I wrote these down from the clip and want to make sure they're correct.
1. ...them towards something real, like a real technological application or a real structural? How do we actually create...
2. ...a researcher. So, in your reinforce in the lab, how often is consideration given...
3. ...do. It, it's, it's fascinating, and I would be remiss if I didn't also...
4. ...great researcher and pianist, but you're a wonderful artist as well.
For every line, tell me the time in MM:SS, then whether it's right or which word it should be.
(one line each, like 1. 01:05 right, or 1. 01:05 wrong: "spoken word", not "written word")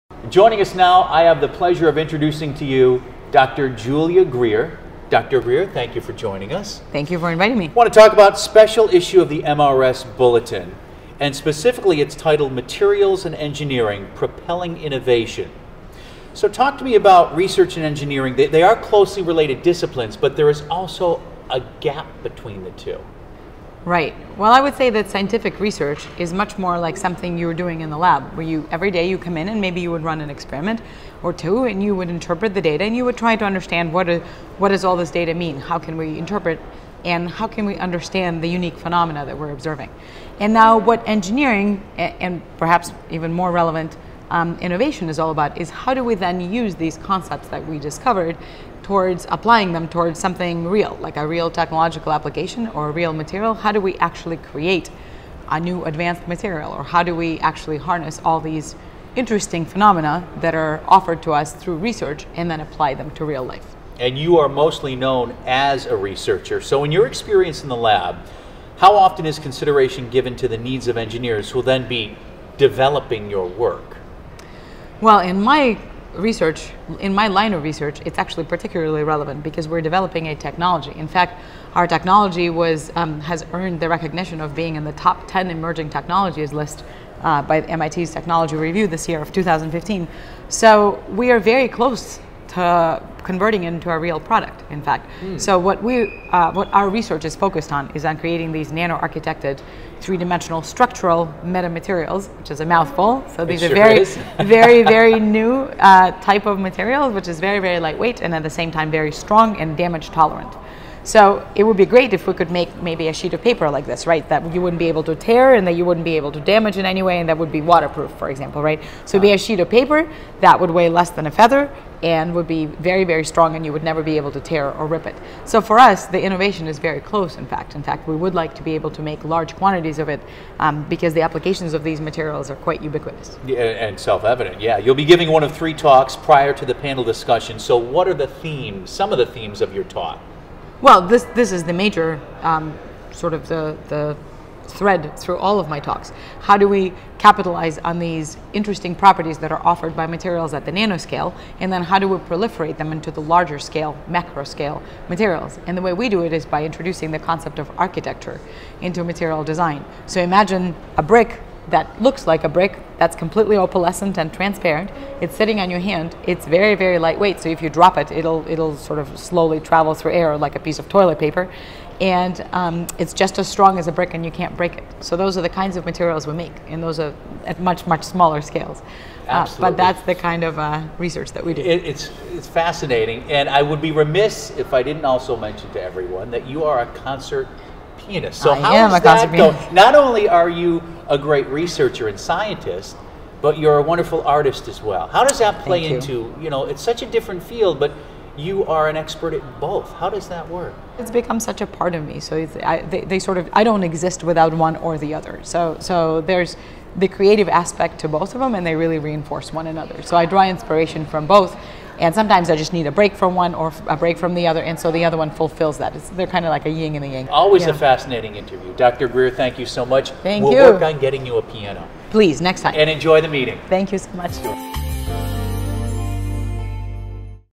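1. 00:49 wrong: "material", not "structural"
2. 01:05 wrong: "experience", not "reinforce"
3. 03:01 right
4. 03:11 wrong: "scientist", not "pianist".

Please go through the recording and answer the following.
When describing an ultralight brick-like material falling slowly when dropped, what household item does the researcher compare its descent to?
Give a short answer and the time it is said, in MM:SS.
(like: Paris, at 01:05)
toilet paper, at 02:50.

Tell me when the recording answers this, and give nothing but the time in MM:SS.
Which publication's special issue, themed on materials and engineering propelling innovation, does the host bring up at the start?
00:09.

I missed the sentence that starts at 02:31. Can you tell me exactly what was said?
And then how do we proliferate them into the larger scale, macro scale materials?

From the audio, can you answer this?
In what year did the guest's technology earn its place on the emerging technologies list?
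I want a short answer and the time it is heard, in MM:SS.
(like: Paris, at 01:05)
2015, at 01:29.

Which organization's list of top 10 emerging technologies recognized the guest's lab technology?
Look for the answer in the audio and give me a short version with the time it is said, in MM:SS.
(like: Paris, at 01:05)
MIT's Technology Review, at 01:27.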